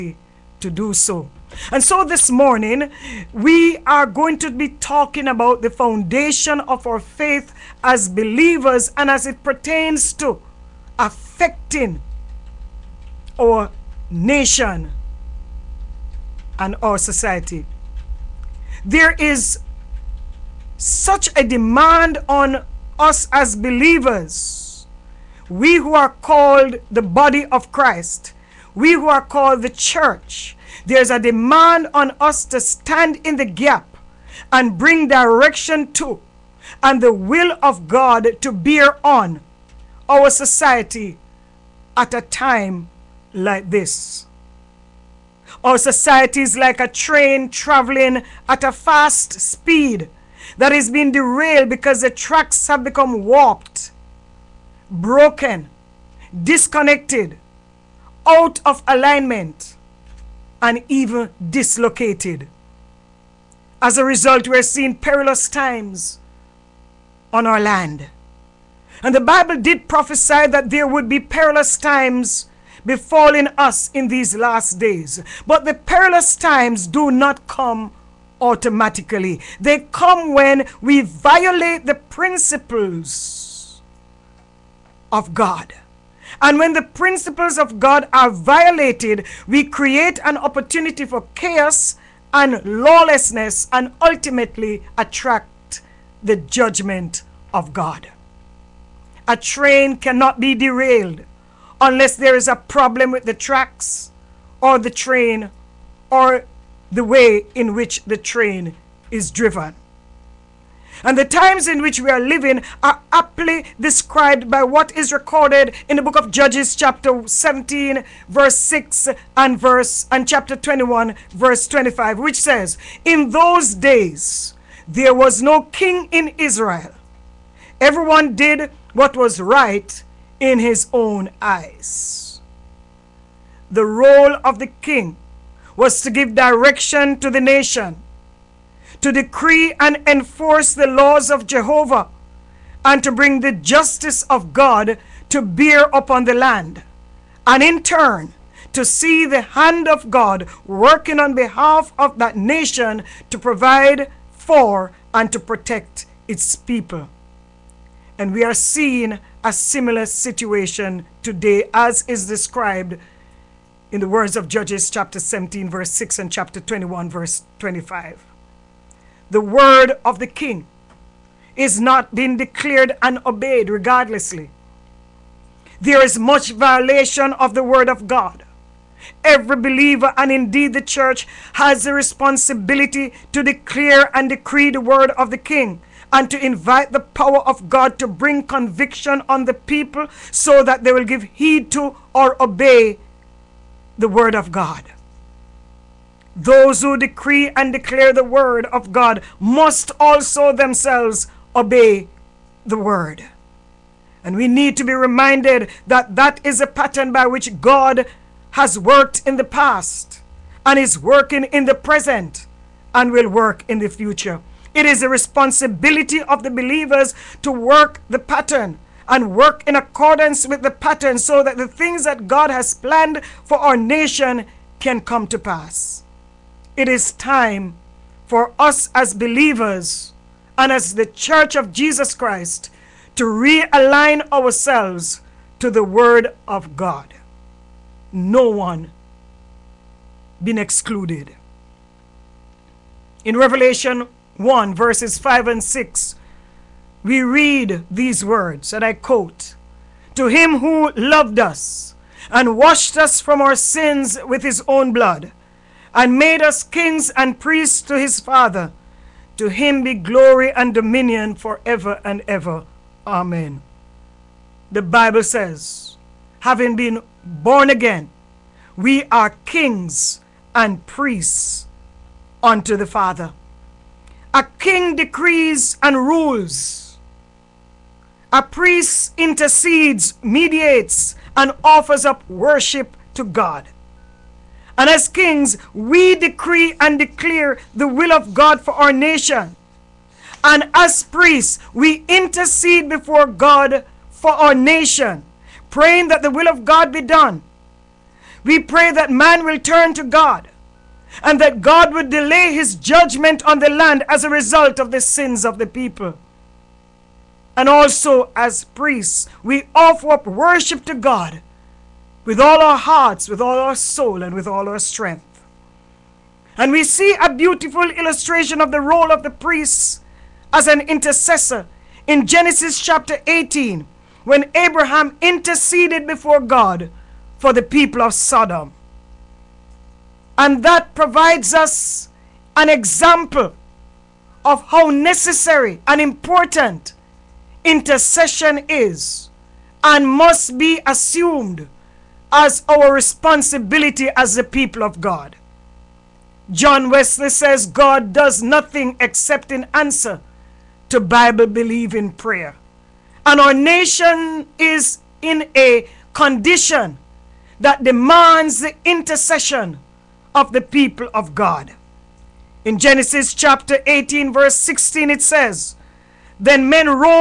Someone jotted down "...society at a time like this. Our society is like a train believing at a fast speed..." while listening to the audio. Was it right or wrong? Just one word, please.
wrong.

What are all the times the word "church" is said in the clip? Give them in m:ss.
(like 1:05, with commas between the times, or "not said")
0:29, 3:00, 3:51.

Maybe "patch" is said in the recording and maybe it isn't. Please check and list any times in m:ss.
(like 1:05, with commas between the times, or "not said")
not said.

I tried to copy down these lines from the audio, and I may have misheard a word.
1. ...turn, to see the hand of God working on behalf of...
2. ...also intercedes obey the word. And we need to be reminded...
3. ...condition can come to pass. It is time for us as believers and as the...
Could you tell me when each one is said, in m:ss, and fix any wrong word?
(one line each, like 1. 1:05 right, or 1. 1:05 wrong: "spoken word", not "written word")
1. 2:27 right
2. 3:19 wrong: "themselves", not "intercedes"
3. 3:43 wrong: "nation", not "condition".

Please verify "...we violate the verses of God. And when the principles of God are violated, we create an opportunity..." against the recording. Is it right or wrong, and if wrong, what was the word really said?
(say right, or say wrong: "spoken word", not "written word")
wrong: "principles", not "verses".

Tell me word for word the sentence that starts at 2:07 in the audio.
Everyone did what was right in his own eyes.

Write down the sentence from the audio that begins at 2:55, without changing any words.
There is much violation of the word of God.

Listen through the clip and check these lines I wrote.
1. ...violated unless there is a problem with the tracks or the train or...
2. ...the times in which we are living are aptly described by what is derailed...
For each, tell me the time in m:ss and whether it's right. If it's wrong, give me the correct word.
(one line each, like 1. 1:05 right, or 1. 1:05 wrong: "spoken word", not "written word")
1. 1:40 wrong: "derailed", not "violated"
2. 1:51 wrong: "recorded", not "derailed".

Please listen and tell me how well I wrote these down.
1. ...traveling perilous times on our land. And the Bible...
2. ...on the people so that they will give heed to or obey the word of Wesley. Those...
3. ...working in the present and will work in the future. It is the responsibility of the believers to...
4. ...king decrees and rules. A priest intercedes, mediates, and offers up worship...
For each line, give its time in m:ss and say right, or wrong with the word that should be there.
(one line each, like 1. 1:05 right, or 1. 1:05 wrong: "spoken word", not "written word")
1. 1:04 wrong: "seeing", not "traveling"
2. 3:09 wrong: "God", not "Wesley"
3. 3:30 right
4. 4:34 right.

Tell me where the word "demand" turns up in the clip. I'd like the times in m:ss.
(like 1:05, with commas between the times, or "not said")
0:21, 0:31, 5:57.